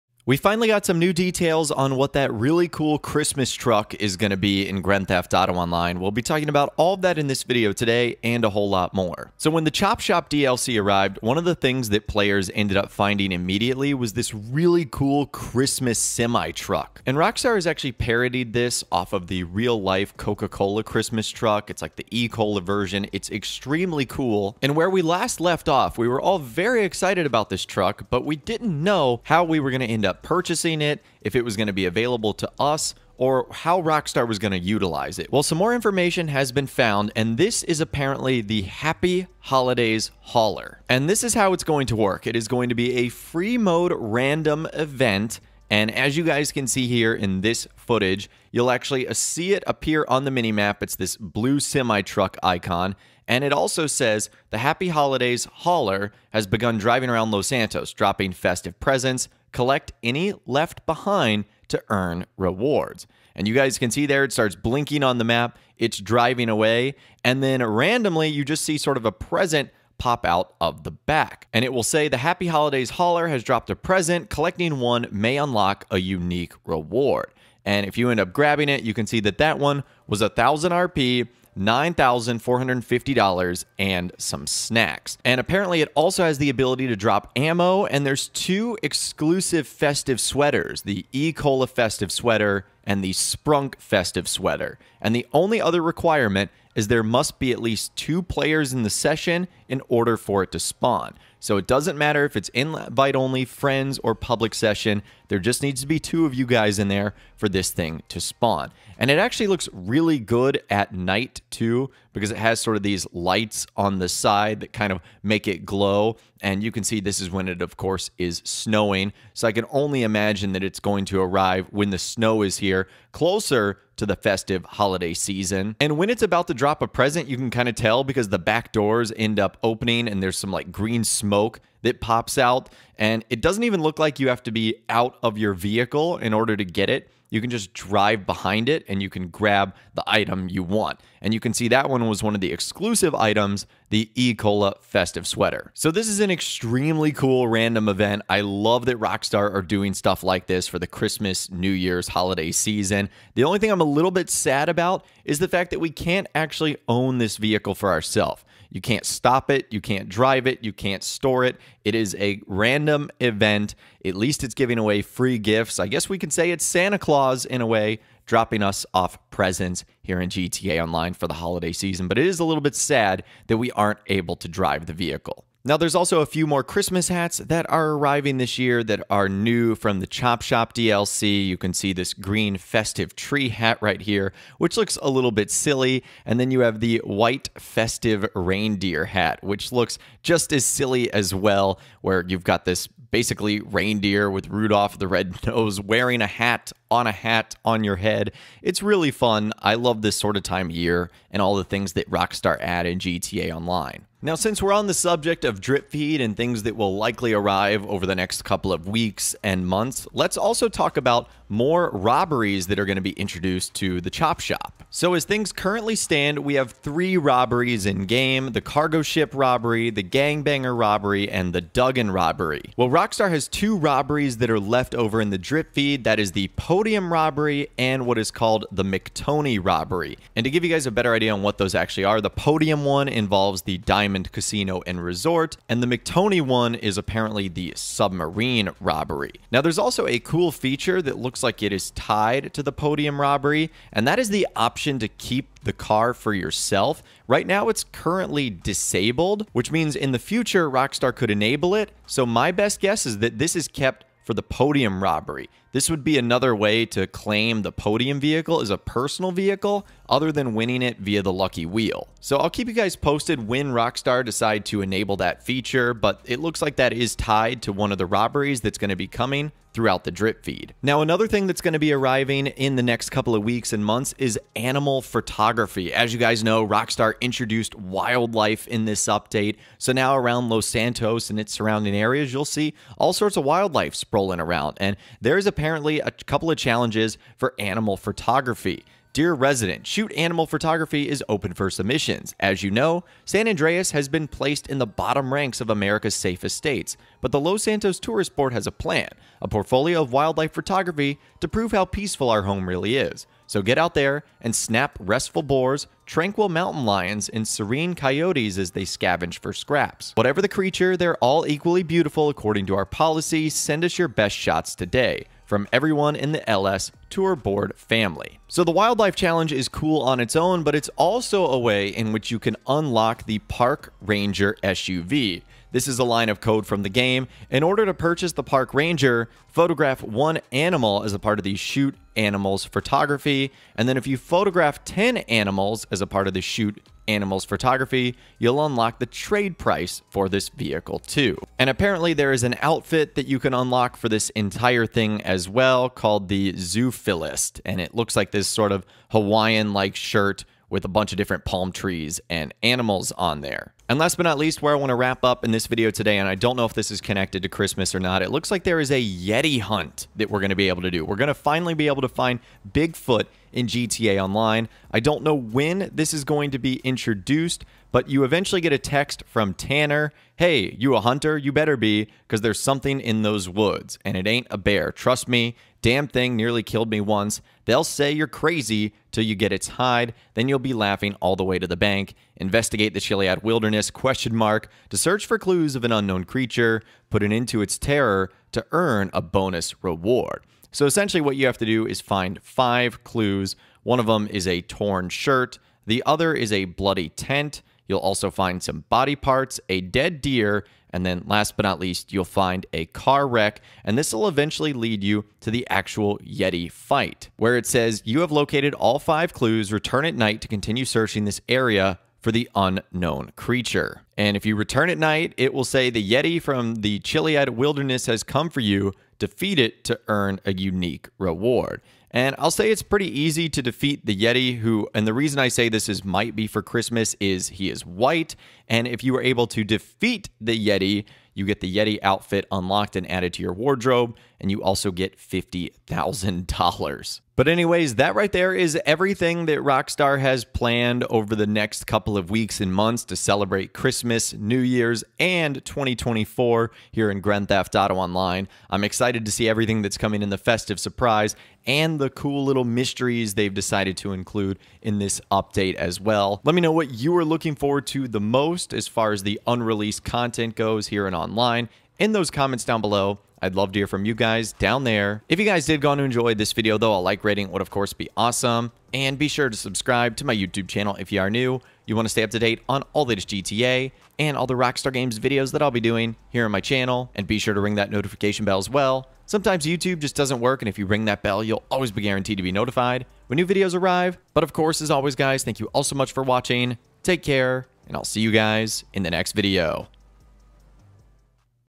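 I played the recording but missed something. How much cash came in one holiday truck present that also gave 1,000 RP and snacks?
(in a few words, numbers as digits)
$9,450.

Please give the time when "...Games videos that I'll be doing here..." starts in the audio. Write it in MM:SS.
07:54.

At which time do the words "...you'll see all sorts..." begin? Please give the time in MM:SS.
04:42.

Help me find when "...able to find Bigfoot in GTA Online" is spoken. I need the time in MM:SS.
06:01.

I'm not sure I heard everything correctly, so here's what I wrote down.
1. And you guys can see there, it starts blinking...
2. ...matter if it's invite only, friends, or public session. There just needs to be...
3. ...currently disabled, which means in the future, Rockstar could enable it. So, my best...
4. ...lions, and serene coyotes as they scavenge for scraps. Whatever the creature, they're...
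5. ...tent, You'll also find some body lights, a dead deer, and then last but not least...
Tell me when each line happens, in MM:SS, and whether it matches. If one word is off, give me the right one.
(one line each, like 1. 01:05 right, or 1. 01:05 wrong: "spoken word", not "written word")
1. 01:03 right
2. 01:41 right
3. 04:07 right
4. 05:06 right
5. 06:37 wrong: "parts", not "lights".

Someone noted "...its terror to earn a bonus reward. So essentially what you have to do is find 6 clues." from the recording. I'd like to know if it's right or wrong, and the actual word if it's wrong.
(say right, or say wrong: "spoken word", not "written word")
wrong: "5", not "6".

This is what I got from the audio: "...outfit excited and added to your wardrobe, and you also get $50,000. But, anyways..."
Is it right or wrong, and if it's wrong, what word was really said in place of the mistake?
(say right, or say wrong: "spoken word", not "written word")
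wrong: "unlocked", not "excited".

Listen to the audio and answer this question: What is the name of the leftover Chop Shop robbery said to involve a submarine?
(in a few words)
McTony robbery.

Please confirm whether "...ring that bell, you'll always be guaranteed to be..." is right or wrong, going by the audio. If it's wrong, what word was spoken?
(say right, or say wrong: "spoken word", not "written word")
right.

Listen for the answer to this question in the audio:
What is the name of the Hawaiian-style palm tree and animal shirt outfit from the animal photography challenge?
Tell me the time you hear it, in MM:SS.
05:46.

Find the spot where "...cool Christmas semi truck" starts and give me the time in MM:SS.
00:14.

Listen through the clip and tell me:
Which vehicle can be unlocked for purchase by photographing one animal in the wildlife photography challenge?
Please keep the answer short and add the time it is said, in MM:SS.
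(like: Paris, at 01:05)
Park Ranger SUV, at 05:23.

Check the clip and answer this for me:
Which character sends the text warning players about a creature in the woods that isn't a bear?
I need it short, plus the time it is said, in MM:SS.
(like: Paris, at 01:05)
Tanner, at 06:09.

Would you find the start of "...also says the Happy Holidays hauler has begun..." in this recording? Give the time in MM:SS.
00:53.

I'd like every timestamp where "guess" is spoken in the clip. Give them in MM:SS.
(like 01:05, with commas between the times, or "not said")
02:45, 04:12.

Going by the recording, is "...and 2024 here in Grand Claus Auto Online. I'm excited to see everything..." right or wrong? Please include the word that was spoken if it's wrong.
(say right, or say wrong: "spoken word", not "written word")
wrong: "Theft", not "Claus".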